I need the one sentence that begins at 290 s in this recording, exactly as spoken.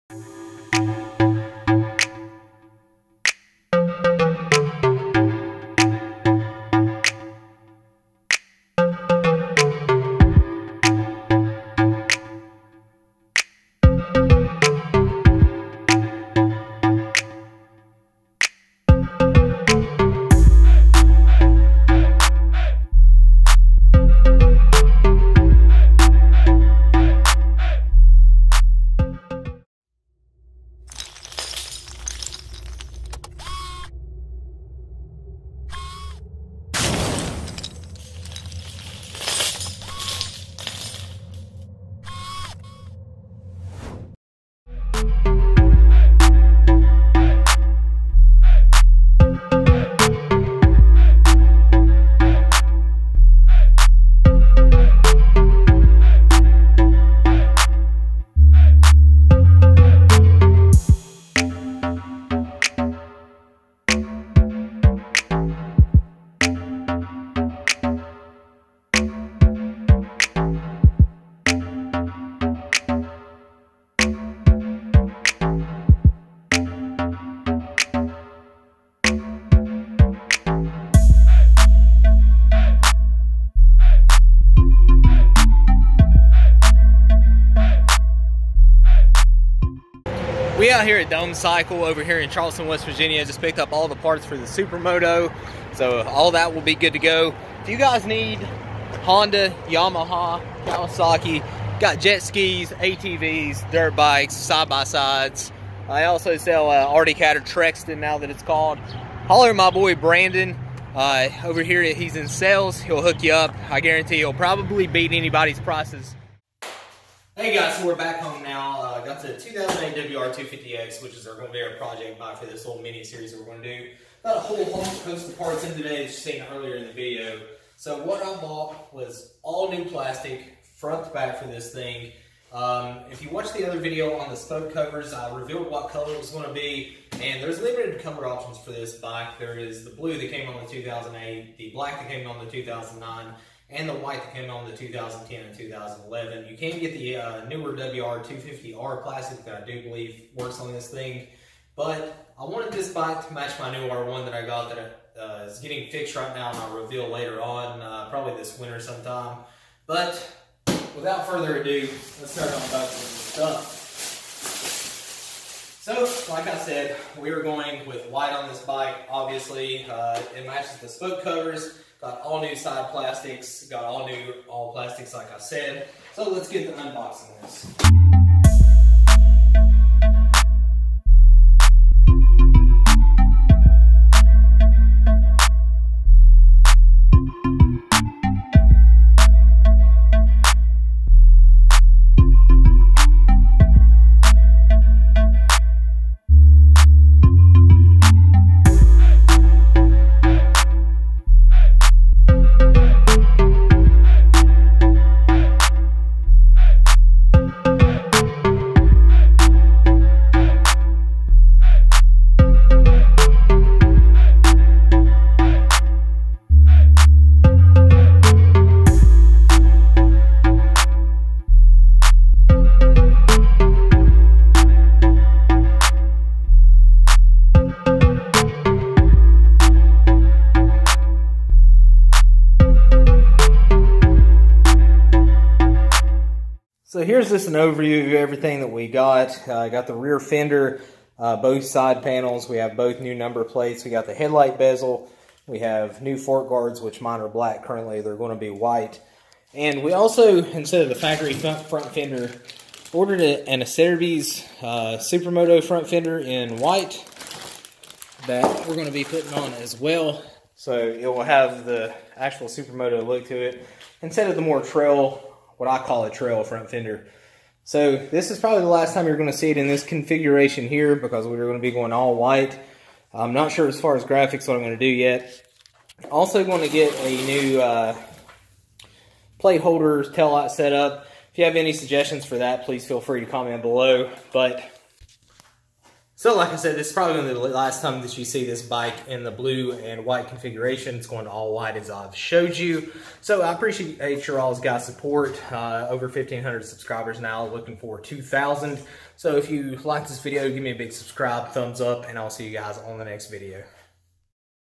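It's going all white as I've showed you.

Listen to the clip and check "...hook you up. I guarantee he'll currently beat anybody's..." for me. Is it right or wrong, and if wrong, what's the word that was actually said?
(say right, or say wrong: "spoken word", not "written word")
wrong: "probably", not "currently".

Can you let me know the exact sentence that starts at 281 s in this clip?
If you have any suggestions for that, please feel free to comment below.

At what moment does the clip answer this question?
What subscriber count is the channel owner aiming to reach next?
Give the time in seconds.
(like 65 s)
297 s.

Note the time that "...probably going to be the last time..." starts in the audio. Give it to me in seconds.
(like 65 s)
286 s.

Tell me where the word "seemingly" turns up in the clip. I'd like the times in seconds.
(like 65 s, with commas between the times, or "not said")
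not said.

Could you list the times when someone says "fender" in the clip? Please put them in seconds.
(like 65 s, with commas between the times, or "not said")
240 s, 251 s, 255 s, 266 s.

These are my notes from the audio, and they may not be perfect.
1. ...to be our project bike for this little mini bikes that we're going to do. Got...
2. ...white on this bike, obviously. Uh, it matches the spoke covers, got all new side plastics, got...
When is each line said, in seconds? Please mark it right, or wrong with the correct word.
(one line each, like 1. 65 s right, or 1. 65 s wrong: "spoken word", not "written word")
1. 121 s wrong: "series", not "bikes"
2. 168 s right.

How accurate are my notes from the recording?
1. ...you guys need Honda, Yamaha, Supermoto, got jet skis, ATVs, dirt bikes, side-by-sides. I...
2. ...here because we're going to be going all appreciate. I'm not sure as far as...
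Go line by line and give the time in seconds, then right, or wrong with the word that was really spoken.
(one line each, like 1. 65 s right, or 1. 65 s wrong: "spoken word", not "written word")
1. 97 s wrong: "Kawasaki", not "Supermoto"
2. 270 s wrong: "white", not "appreciate".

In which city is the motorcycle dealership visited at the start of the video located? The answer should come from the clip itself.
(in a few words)
Charleston, West Virginia.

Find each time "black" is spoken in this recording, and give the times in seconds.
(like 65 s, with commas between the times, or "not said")
141 s, 247 s.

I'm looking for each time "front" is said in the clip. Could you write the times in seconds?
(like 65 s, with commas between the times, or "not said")
130 s, 251 s, 255 s, 266 s.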